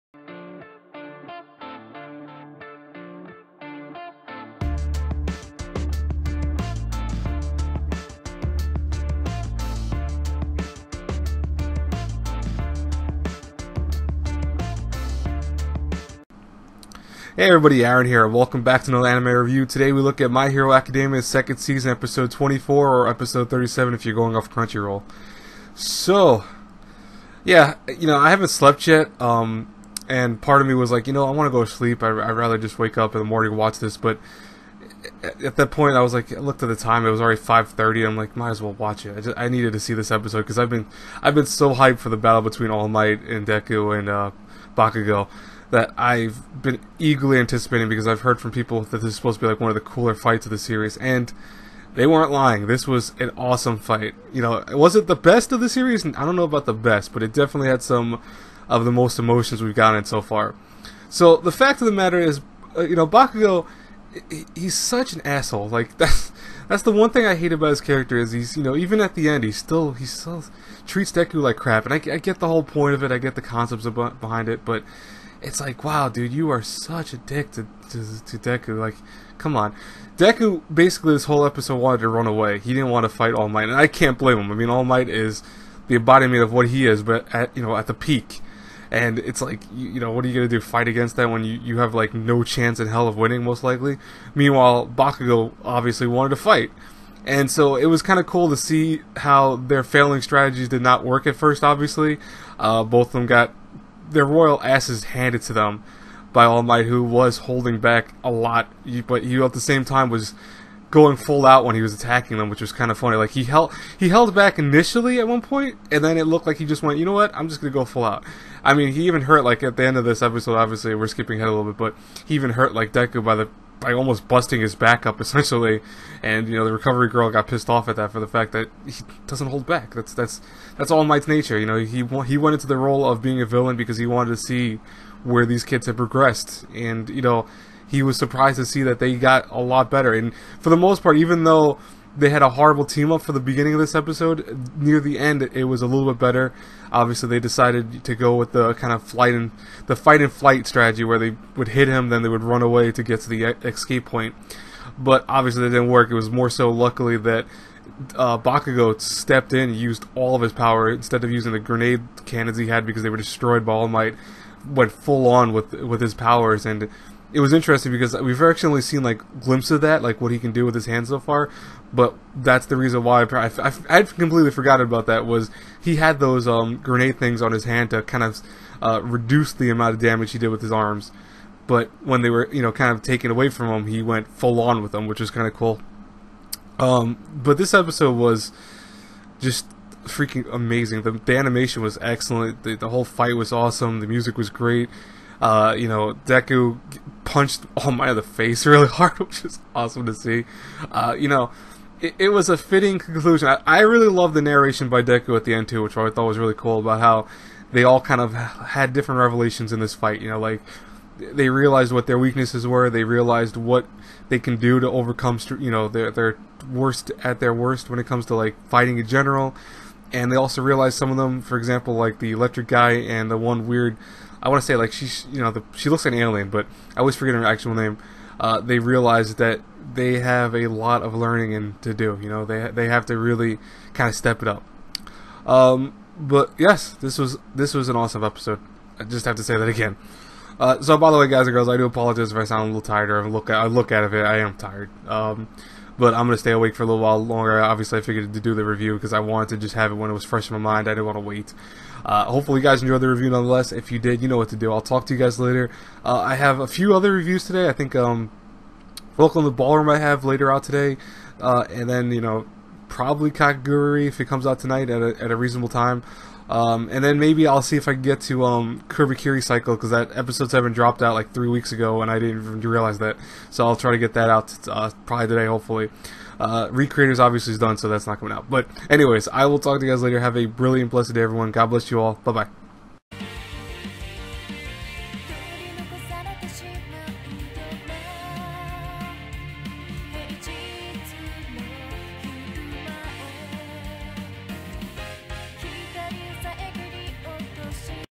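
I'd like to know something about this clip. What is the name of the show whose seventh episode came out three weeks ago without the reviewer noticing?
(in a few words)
Kirikiri Cycle.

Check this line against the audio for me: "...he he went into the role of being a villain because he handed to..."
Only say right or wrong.
wrong.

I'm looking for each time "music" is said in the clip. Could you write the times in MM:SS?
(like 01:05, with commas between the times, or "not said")
03:14.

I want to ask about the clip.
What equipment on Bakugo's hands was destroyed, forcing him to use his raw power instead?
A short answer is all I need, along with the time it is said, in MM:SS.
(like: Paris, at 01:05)
grenade cannons, at 02:41.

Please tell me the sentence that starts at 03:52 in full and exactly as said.
You know, they they have to really kind of step it up.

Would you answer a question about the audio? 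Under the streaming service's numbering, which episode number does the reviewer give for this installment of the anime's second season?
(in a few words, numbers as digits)
37.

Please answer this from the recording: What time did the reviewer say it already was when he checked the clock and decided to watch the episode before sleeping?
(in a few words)
5:30.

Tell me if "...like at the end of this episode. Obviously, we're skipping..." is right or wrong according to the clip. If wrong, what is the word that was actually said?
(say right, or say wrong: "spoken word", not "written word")
right.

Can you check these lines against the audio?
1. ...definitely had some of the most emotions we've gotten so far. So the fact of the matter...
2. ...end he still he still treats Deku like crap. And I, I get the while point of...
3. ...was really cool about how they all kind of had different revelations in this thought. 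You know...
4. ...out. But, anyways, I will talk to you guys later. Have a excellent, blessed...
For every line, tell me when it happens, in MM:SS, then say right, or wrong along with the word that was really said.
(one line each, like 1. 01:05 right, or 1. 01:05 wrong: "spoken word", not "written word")
1. 00:57 right
2. 01:09 wrong: "whole", not "while"
3. 03:26 wrong: "fight", not "thought"
4. 04:38 wrong: "brilliant", not "excellent".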